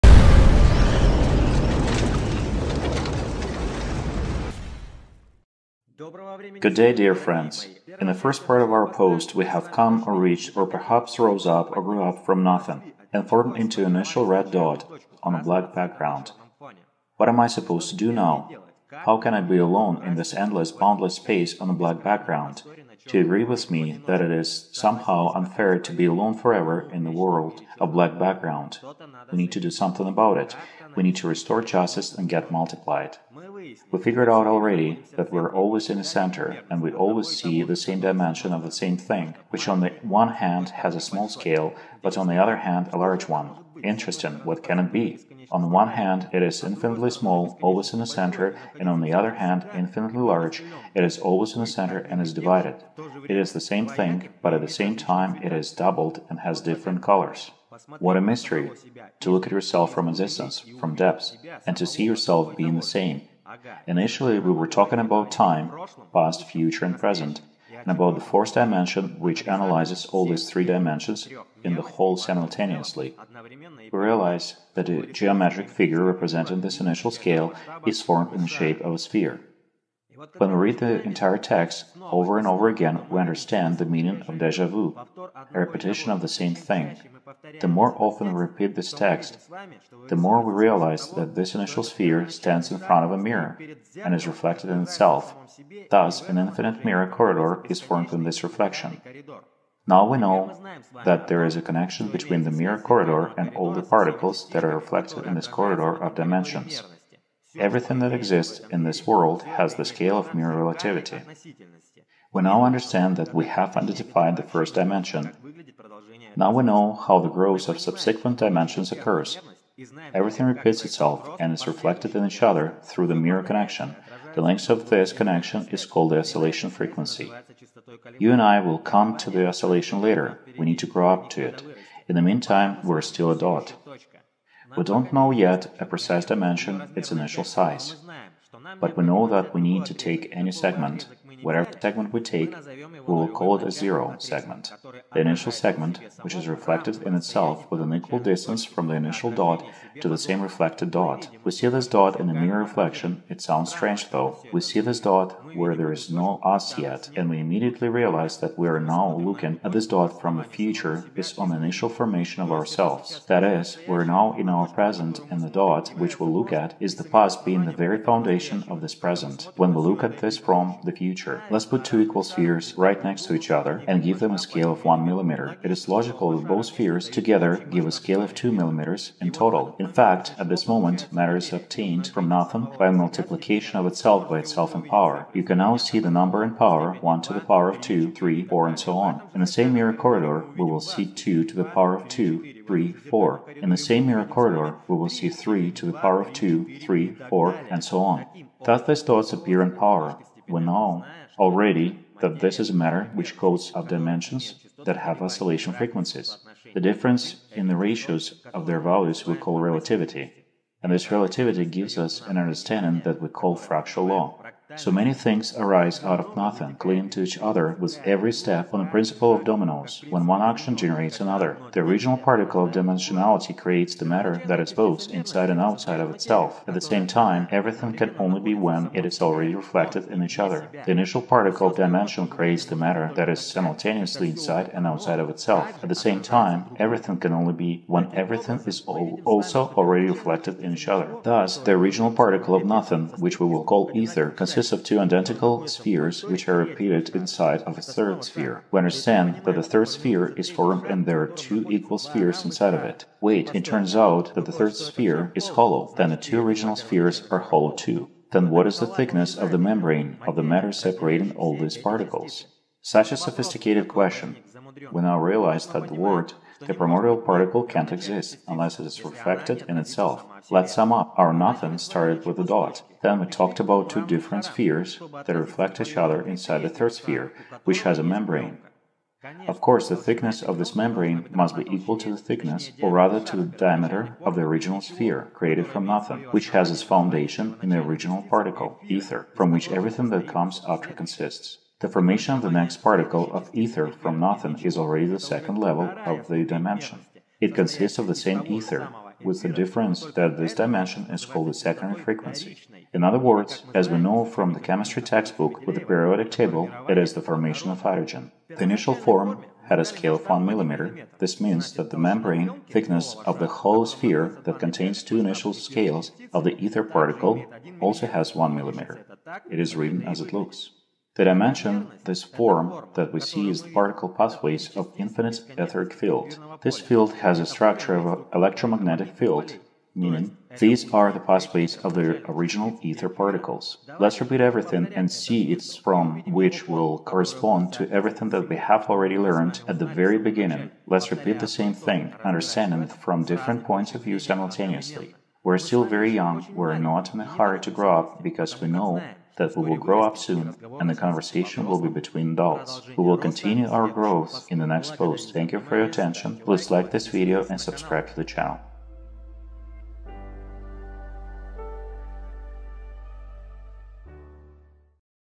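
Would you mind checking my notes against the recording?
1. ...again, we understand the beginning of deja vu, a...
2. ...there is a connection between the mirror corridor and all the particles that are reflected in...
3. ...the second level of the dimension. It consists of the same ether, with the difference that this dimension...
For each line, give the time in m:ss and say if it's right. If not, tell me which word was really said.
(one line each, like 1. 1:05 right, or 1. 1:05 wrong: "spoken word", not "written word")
1. 1:22 wrong: "meaning", not "beginning"
2. 1:41 right
3. 4:55 right.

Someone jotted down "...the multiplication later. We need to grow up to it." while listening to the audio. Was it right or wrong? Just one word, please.
wrong.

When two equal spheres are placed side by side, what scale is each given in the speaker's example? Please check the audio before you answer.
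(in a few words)
1 millimeter.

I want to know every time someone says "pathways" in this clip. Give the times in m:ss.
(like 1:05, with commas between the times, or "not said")
5:24, 5:31.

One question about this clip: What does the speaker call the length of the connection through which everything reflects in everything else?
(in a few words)
Oscillation frequency.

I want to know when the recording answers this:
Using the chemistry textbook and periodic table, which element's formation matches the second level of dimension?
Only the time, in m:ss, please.
5:07.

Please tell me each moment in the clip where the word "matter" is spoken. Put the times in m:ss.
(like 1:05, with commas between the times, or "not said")
3:01, 3:22, 3:44, 3:52, 4:20.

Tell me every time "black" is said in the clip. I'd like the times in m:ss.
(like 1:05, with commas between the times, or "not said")
0:15, 0:21, 0:27.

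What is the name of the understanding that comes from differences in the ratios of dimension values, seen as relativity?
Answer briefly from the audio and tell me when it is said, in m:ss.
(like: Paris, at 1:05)
Fractal law, at 3:33.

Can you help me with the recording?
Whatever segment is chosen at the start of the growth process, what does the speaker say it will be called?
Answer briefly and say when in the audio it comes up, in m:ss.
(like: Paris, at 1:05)
Zero segment, at 2:23.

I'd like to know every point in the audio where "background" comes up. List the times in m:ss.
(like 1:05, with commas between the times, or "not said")
0:15, 0:22, 0:28.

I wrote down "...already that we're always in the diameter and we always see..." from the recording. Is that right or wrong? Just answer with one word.
wrong.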